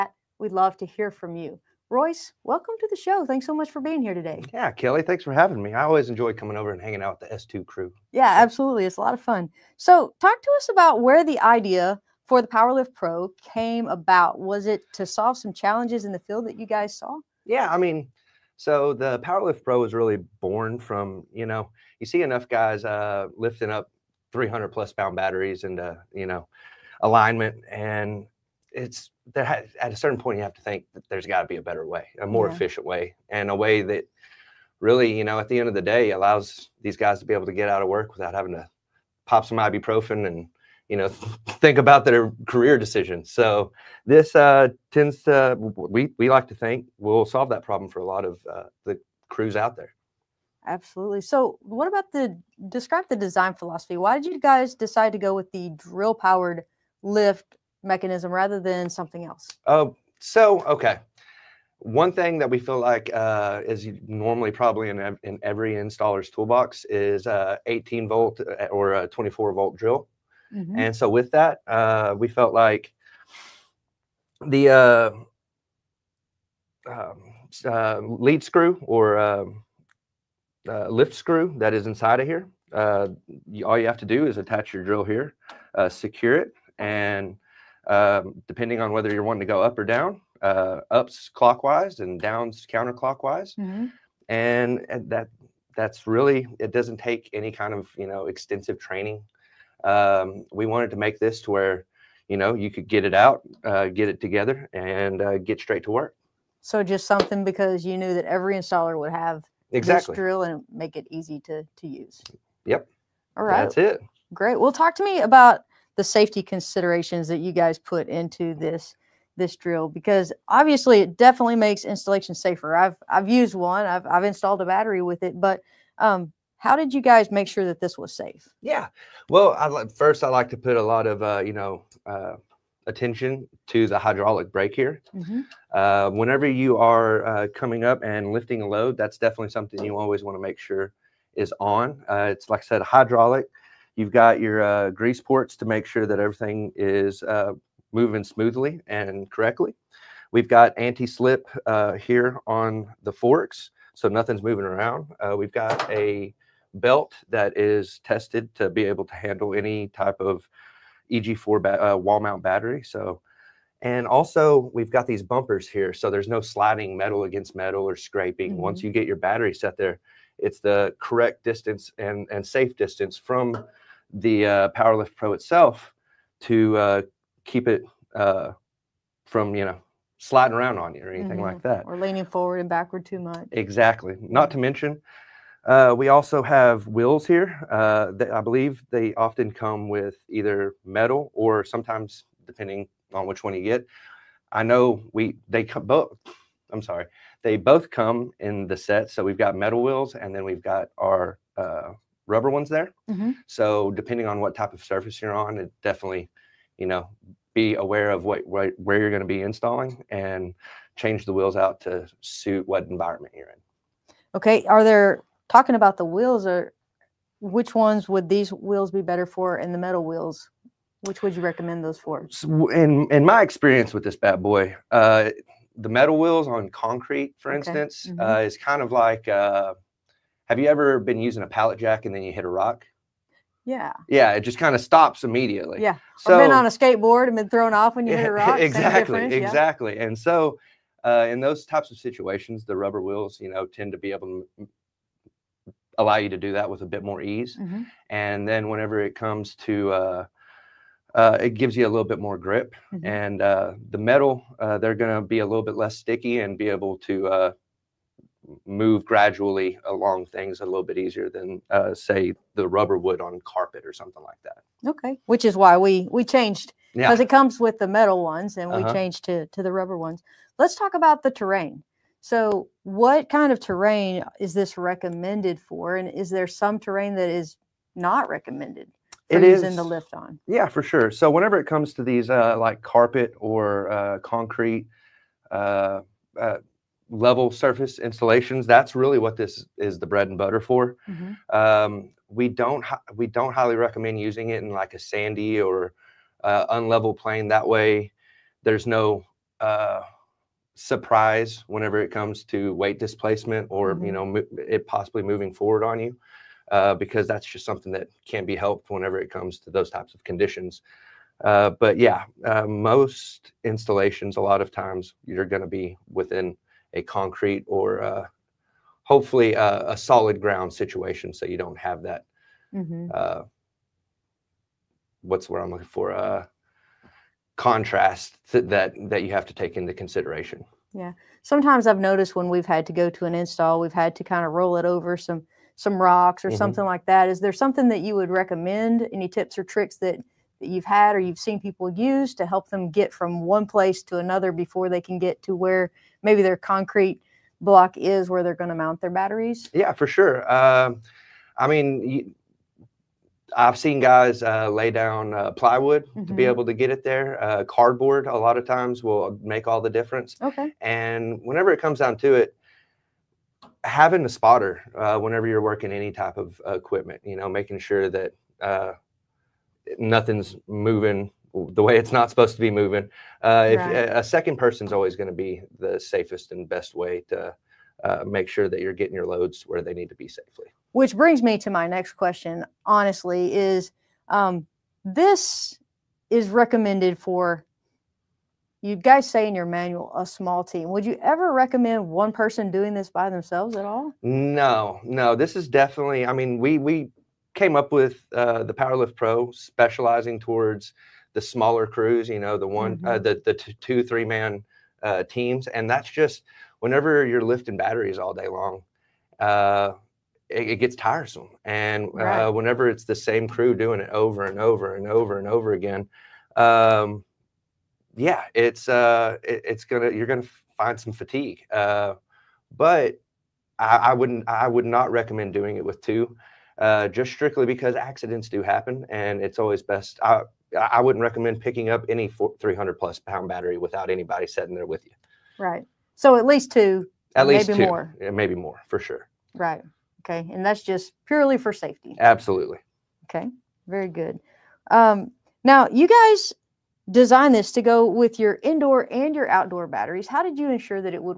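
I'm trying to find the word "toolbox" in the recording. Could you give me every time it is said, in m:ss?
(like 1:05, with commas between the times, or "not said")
1:06.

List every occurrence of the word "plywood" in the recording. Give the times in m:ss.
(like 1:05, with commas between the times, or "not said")
5:55.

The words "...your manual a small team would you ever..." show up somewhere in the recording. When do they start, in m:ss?
6:29.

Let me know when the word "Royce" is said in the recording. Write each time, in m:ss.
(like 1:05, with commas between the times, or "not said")
0:01.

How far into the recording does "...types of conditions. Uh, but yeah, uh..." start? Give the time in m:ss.
5:09.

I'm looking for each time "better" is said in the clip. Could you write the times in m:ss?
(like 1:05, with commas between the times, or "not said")
0:31, 3:39.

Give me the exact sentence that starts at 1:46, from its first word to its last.
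So just something because you knew that every installer would have exactly.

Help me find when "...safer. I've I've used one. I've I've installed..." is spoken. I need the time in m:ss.
2:02.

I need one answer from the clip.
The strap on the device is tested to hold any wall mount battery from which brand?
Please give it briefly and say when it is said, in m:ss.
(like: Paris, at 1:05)
EG4, at 2:41.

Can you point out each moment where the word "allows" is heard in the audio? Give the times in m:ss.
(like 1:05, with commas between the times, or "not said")
0:36, 4:05.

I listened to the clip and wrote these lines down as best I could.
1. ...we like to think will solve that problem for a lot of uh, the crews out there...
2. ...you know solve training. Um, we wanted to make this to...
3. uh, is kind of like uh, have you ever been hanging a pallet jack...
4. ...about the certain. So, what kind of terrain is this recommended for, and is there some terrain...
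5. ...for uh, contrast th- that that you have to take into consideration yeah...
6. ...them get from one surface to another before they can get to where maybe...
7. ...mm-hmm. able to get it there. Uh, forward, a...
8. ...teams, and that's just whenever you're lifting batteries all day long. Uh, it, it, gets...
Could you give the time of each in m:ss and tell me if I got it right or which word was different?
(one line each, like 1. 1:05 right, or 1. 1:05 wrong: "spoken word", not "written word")
1. 0:46 right
2. 1:37 wrong: "extensive", not "solve"
3. 3:48 wrong: "using", not "hanging"
4. 4:30 wrong: "terrain", not "certain"
5. 5:25 right
6. 5:42 wrong: "place", not "surface"
7. 5:56 wrong: "cardboard", not "forward"
8. 6:45 right.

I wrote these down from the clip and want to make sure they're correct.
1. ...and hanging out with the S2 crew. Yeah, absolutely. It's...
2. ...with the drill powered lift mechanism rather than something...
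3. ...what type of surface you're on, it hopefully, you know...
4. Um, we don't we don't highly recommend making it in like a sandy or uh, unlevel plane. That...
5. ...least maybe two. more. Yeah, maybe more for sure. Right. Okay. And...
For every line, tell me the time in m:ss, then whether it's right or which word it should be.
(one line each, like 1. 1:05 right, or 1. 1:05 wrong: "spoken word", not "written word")
1. 0:06 right
2. 0:55 right
3. 3:24 wrong: "definitely", not "hopefully"
4. 4:51 wrong: "using", not "making"
5. 7:17 right.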